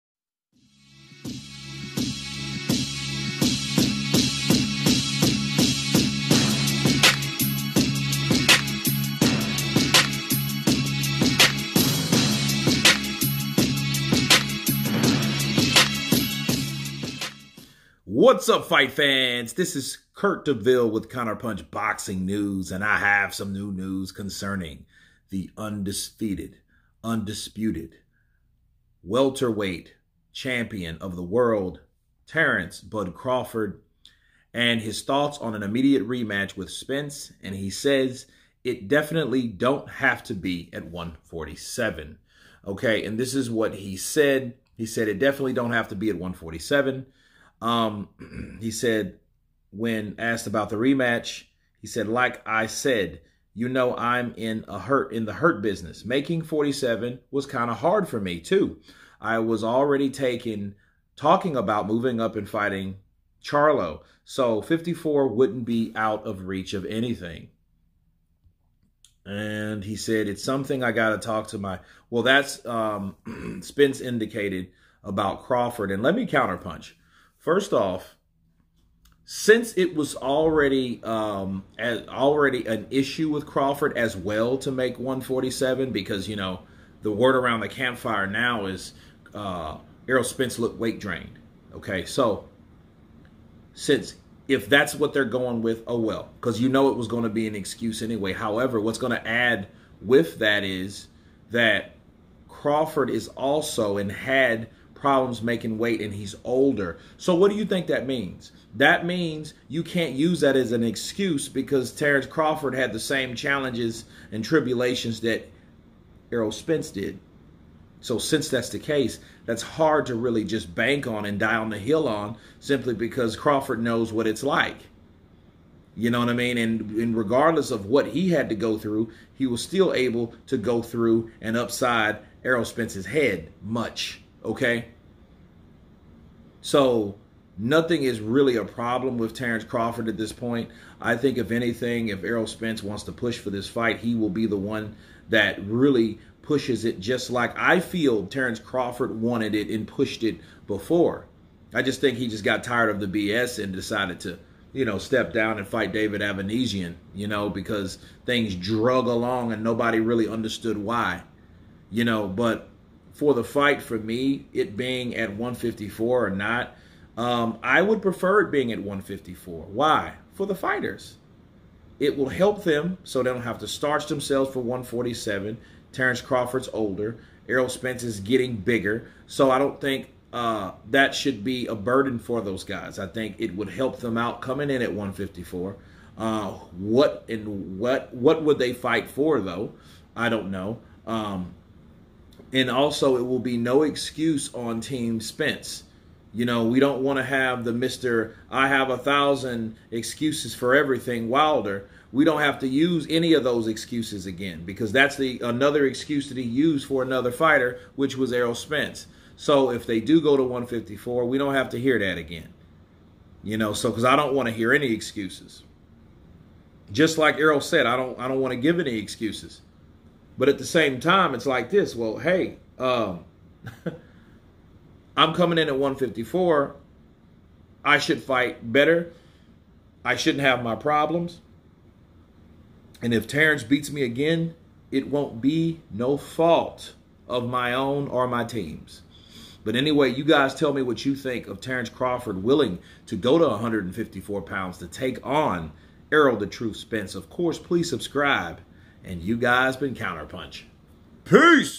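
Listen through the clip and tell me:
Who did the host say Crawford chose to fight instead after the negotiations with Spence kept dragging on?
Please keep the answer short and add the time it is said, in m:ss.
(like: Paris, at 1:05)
David Avanesyan, at 2:35.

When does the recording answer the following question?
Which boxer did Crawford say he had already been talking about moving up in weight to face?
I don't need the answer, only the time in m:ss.
1:03.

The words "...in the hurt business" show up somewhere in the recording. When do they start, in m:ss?
0:55.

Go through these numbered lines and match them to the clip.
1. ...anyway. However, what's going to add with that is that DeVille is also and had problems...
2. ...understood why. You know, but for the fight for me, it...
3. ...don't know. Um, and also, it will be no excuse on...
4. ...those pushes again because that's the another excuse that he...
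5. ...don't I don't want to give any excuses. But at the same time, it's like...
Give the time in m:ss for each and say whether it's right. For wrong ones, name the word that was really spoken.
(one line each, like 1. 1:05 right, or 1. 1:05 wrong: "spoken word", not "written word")
1. 1:38 wrong: "Crawford", not "DeVille"
2. 2:40 right
3. 3:10 right
4. 3:23 wrong: "excuses", not "pushes"
5. 3:37 right.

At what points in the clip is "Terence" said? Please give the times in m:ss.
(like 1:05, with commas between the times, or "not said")
0:32, 1:51, 2:19, 2:28, 2:55, 3:53, 4:01.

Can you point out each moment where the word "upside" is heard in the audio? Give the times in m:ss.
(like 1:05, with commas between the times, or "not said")
2:11.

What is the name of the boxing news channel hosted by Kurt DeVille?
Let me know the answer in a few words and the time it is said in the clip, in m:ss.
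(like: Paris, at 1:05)
Counterpunch Boxing News, at 0:21.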